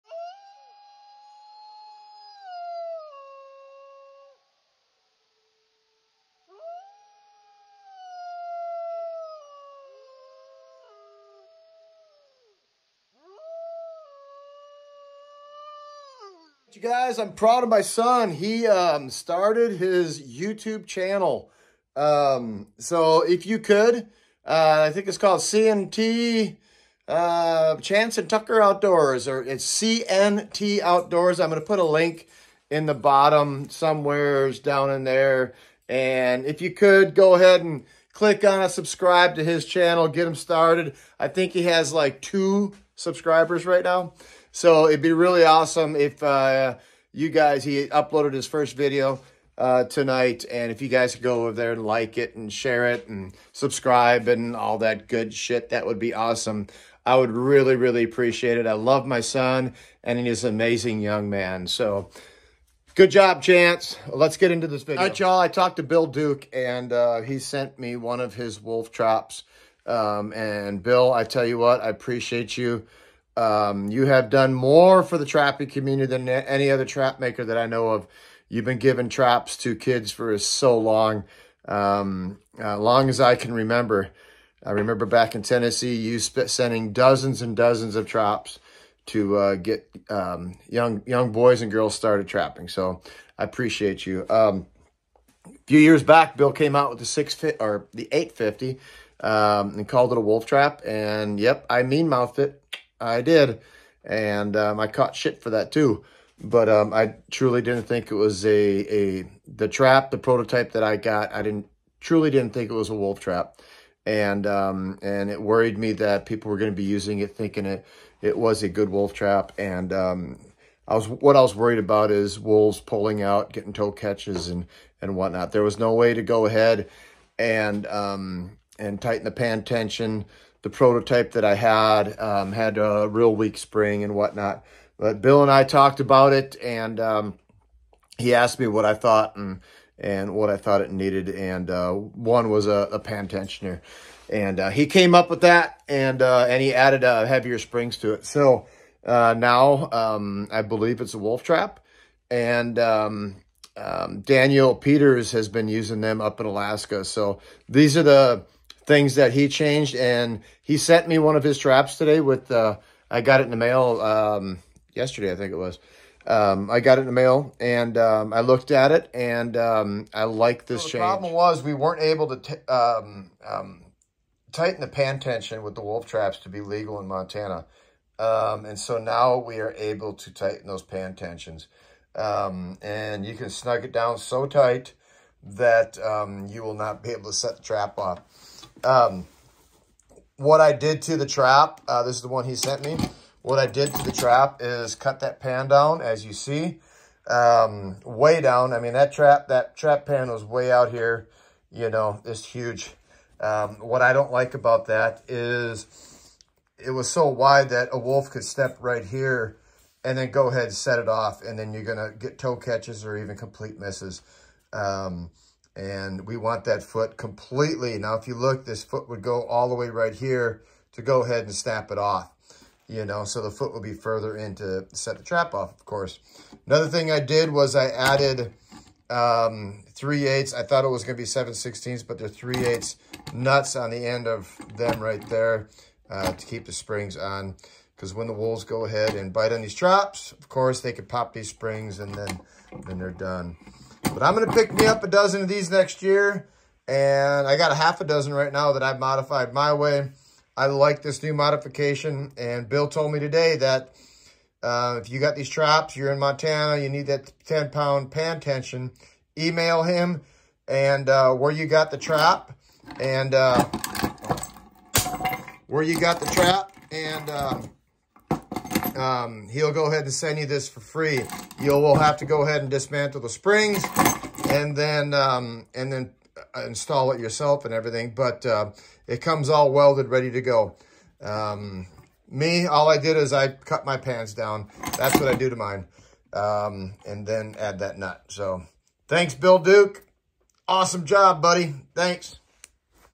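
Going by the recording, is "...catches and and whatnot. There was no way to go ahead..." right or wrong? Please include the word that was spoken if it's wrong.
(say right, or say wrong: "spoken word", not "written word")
right.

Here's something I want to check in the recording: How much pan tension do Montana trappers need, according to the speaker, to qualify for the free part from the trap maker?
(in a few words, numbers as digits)
10 pounds.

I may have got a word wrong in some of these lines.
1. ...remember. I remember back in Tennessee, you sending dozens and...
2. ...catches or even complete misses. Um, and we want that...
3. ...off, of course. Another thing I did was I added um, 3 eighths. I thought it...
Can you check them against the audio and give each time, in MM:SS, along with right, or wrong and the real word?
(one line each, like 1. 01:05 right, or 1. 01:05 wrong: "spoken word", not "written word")
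1. 01:23 right
2. 03:32 right
3. 03:45 right.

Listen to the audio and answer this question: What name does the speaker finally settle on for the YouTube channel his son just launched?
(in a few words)
CNT Outdoors.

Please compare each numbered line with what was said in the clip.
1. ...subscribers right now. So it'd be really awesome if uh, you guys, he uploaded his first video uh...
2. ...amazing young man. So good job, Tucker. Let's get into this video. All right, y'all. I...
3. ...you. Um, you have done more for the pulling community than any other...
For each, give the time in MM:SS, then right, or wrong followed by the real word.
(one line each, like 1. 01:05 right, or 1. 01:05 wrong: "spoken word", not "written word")
1. 00:42 right
2. 01:00 wrong: "Chance", not "Tucker"
3. 01:12 wrong: "trapping", not "pulling".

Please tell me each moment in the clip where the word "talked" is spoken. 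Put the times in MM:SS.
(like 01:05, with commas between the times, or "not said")
01:05, 02:15.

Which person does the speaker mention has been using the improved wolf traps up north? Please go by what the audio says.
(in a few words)
Daniel Peters.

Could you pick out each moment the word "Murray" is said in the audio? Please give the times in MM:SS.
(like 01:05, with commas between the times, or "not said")
not said.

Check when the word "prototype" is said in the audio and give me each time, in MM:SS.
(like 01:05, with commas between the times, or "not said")
01:50, 02:10.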